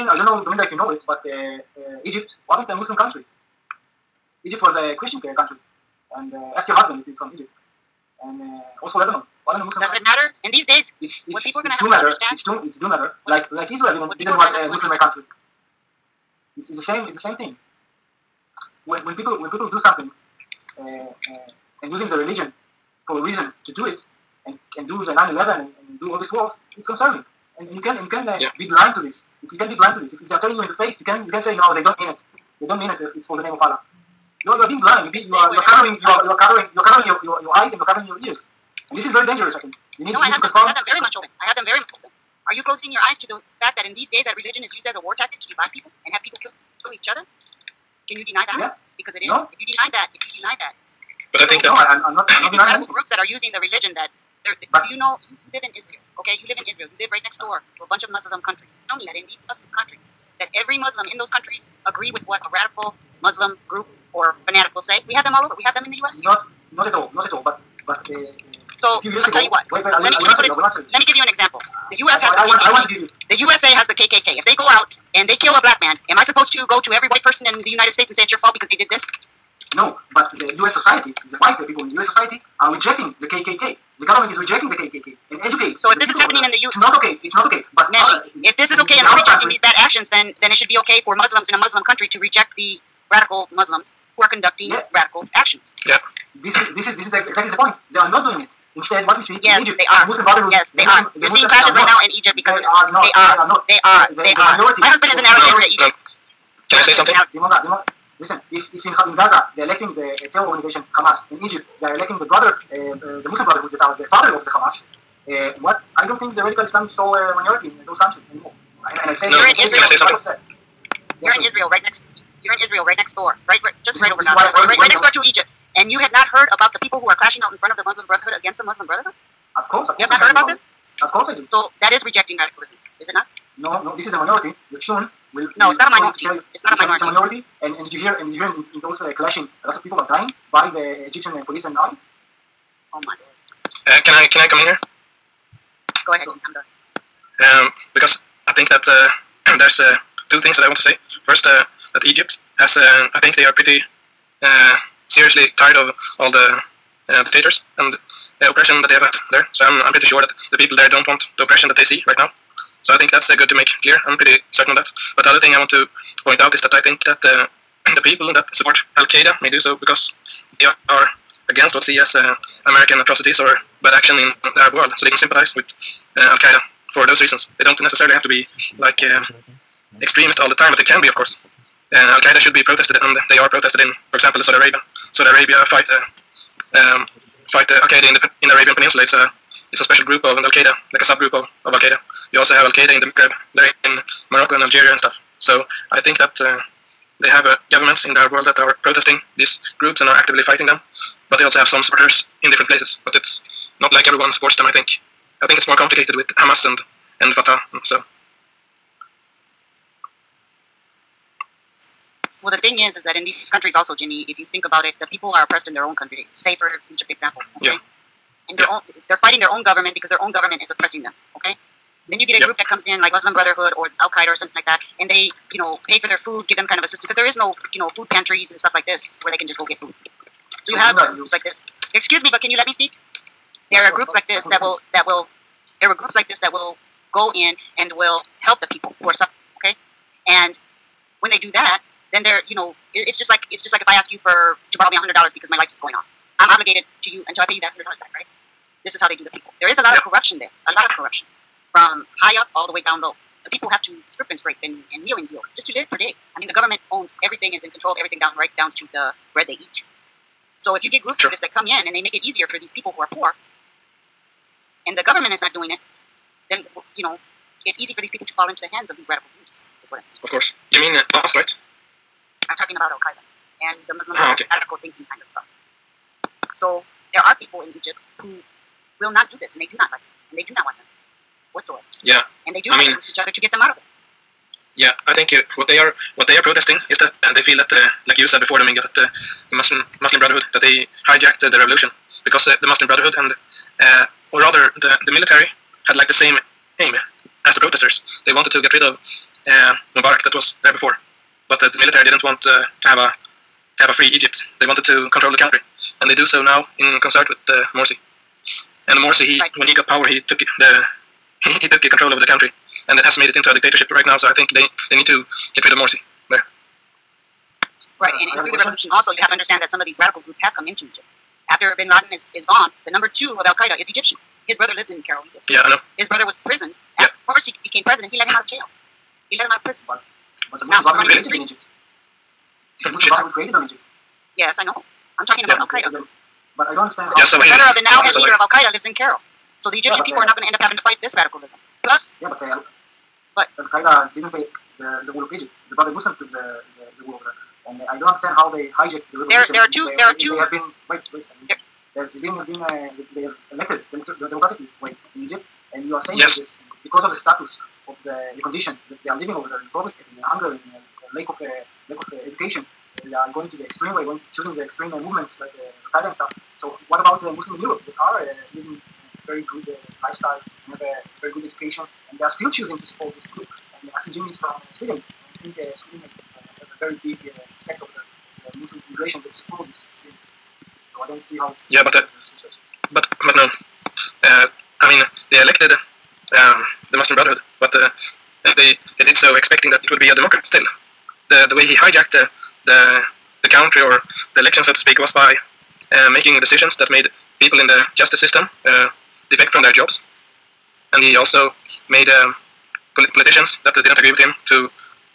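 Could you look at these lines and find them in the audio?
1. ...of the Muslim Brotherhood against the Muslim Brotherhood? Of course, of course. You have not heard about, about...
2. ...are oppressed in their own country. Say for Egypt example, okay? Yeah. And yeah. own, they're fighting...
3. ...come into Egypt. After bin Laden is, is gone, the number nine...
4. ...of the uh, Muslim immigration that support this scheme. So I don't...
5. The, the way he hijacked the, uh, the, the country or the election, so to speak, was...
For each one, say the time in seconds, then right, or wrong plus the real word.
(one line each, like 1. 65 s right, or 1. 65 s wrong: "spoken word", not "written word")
1. 127 s right
2. 215 s right
3. 320 s wrong: "two", not "nine"
4. 377 s right
5. 391 s right.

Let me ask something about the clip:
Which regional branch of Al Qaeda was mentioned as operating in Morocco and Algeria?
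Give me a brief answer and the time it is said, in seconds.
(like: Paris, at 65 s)
Al Qaeda in the Maghreb, at 192 s.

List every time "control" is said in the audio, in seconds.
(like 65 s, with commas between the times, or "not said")
257 s, 305 s, 311 s.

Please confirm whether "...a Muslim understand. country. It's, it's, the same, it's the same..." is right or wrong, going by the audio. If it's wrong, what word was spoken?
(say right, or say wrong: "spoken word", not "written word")
right.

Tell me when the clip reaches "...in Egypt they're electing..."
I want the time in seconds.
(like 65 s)
111 s.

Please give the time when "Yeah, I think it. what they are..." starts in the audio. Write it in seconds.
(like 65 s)
284 s.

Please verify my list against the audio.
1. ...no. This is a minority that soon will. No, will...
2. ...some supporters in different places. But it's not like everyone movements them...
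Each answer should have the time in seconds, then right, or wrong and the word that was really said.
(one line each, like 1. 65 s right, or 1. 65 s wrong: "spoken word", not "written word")
1. 133 s right
2. 201 s wrong: "supports", not "movements".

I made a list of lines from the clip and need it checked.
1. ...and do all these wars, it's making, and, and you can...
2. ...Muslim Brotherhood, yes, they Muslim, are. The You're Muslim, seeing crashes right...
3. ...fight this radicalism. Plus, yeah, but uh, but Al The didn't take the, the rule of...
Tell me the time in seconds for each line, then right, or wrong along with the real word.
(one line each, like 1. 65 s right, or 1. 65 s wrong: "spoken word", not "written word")
1. 25 s wrong: "concerning", not "making"
2. 100 s right
3. 340 s wrong: "Qaeda", not "The".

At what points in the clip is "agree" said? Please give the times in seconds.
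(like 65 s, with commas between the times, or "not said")
61 s, 403 s.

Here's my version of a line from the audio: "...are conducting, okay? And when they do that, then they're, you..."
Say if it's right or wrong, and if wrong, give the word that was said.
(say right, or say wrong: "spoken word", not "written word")
wrong: "suffering", not "conducting".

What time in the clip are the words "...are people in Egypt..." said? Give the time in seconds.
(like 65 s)
277 s.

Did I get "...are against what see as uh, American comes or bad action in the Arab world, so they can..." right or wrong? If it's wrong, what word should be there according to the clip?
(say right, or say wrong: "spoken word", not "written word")
wrong: "atrocities", not "comes".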